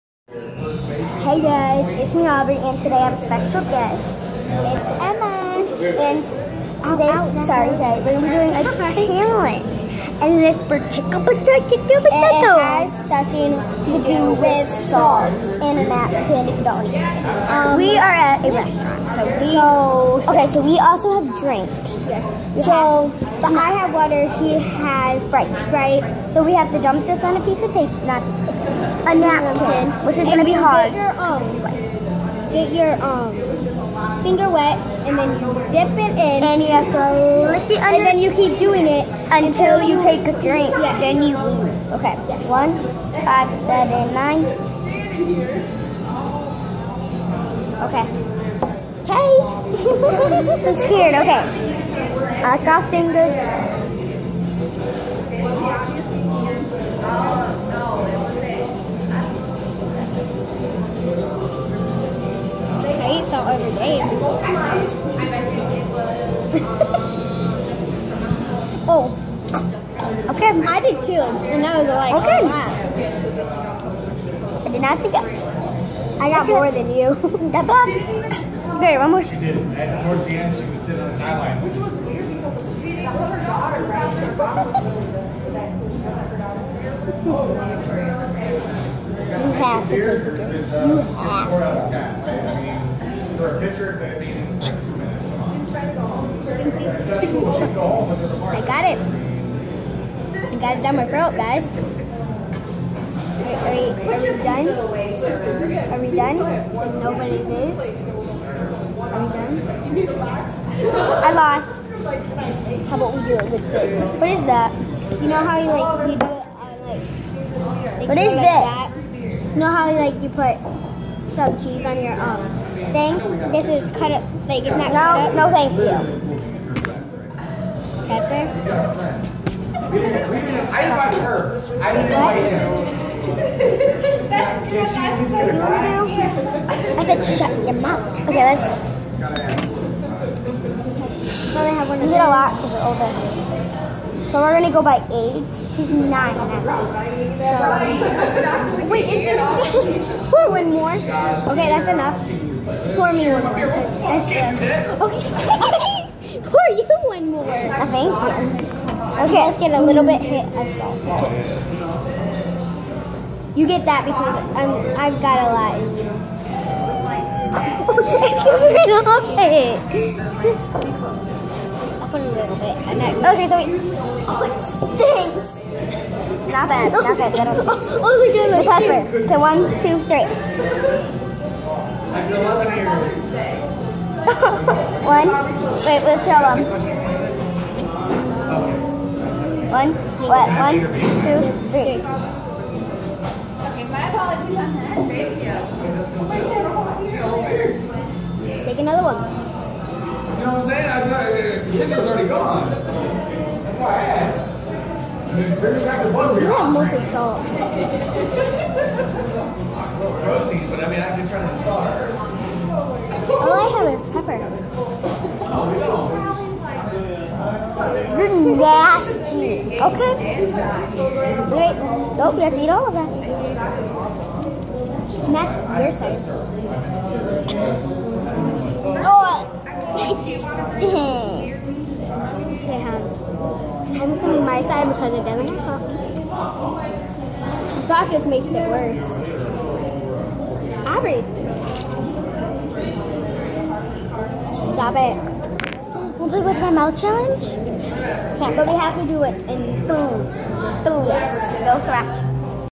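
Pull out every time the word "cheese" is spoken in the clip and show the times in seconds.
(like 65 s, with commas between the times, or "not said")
121 s.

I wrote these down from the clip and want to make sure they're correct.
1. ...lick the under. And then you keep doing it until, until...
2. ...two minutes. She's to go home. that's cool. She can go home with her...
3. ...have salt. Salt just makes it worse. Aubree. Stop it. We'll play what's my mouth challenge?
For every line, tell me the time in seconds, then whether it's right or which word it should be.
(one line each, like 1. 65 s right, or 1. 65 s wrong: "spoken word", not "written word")
1. 37 s right
2. 93 s right
3. 235 s right.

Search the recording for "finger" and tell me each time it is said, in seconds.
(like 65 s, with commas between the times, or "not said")
34 s, 52 s.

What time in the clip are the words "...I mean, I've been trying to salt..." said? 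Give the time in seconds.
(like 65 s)
210 s.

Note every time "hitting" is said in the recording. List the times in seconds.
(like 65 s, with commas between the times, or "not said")
not said.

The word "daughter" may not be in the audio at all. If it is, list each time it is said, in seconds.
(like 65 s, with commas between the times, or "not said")
83 s.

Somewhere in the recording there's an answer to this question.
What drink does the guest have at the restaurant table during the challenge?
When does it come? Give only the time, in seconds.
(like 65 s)
25 s.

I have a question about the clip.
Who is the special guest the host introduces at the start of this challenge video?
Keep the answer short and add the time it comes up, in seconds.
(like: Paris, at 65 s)
Emma, at 5 s.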